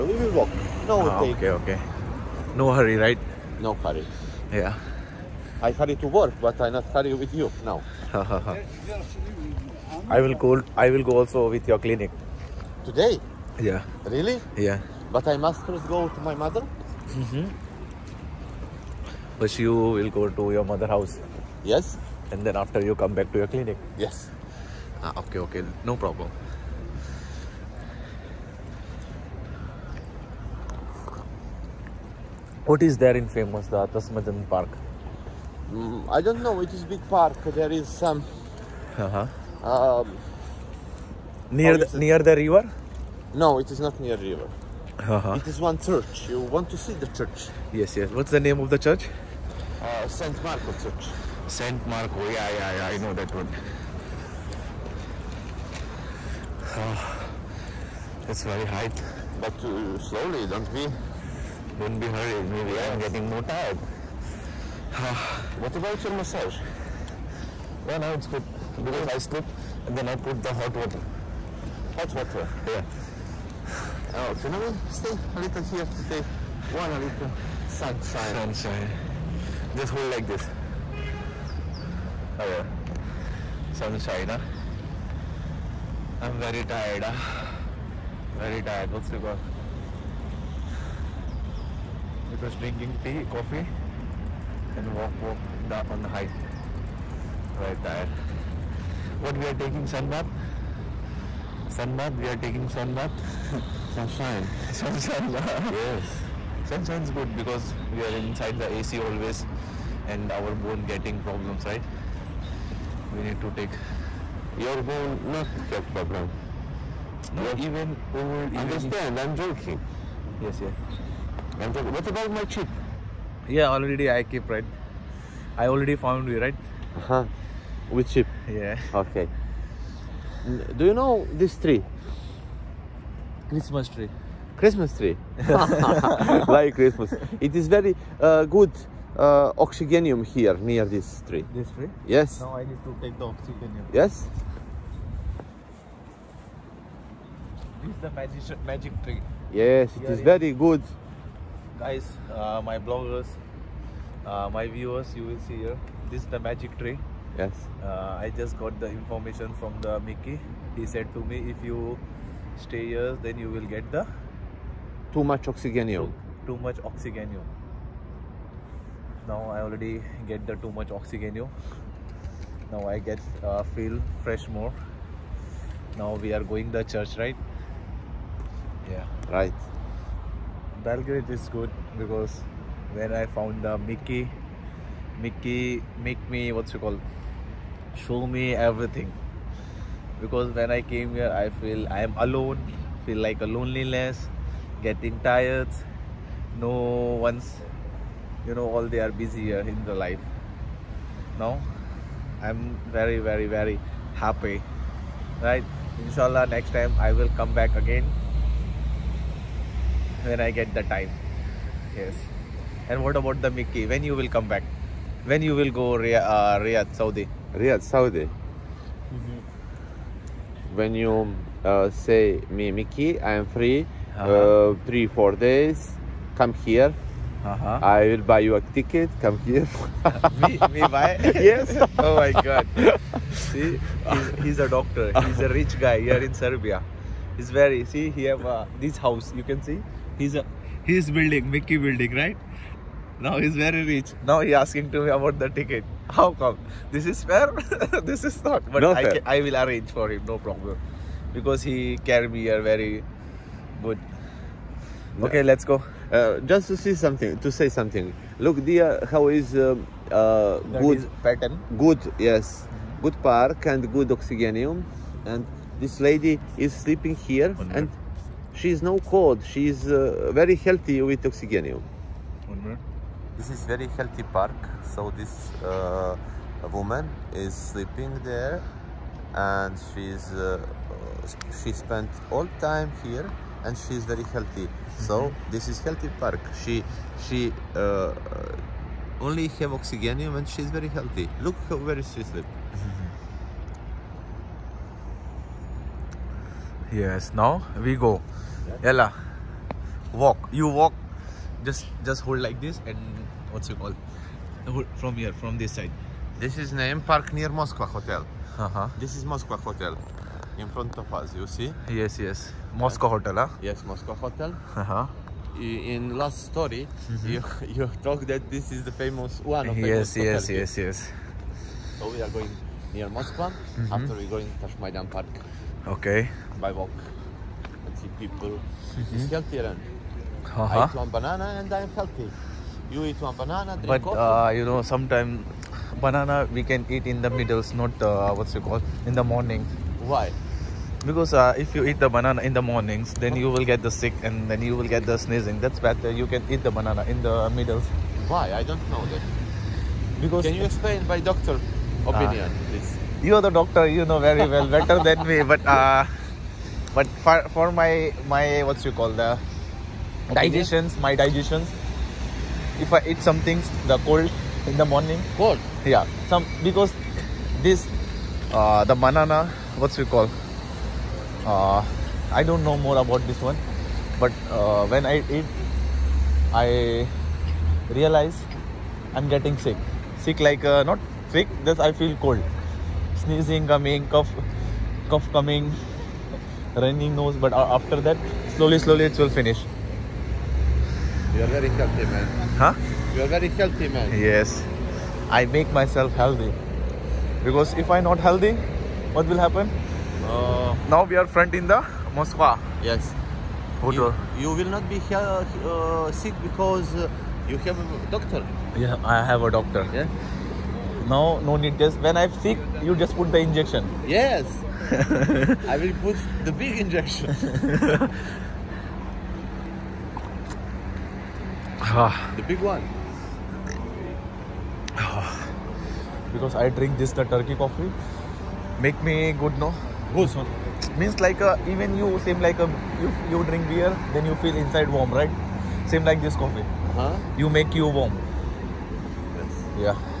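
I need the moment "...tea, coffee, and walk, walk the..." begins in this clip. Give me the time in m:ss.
1:33.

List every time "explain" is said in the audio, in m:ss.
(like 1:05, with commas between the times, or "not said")
5:50.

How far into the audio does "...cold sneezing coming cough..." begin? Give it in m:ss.
6:22.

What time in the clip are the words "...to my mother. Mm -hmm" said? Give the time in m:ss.
0:16.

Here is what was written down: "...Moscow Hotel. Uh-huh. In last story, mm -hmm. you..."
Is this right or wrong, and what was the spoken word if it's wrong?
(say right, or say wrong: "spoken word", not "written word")
right.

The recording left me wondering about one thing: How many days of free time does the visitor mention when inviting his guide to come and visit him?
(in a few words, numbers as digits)
3 or 4 days.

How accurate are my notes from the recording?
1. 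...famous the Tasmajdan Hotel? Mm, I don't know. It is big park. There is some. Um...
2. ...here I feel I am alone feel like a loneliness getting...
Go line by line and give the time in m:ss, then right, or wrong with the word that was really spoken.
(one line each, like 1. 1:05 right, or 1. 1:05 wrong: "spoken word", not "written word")
1. 0:33 wrong: "Park", not "Hotel"
2. 3:11 right.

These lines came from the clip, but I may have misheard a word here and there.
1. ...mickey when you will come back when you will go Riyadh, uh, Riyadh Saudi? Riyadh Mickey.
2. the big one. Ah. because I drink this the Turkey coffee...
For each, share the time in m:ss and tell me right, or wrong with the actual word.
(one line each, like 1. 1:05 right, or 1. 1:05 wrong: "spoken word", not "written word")
1. 3:33 wrong: "Saudi", not "Mickey"
2. 7:02 right.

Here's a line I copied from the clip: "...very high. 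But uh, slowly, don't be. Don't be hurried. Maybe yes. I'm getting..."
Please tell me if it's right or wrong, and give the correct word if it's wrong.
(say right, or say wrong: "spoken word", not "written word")
right.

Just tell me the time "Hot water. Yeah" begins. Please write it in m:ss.
1:11.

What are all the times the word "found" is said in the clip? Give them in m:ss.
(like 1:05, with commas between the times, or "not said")
2:05, 3:03.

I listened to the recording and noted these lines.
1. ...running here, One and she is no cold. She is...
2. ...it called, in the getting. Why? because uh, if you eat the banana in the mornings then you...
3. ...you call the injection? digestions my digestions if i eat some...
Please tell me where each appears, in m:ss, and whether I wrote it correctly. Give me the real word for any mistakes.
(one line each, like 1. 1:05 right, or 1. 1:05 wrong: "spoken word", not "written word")
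1. 4:26 wrong: "sleeping", not "running"
2. 5:38 wrong: "morning", not "getting"
3. 5:58 wrong: "opinion", not "injection".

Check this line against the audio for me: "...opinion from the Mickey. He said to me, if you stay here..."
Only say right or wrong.
wrong.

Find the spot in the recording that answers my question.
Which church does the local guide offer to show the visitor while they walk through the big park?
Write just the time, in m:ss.
0:50.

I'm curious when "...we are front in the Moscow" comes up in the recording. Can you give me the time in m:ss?
6:41.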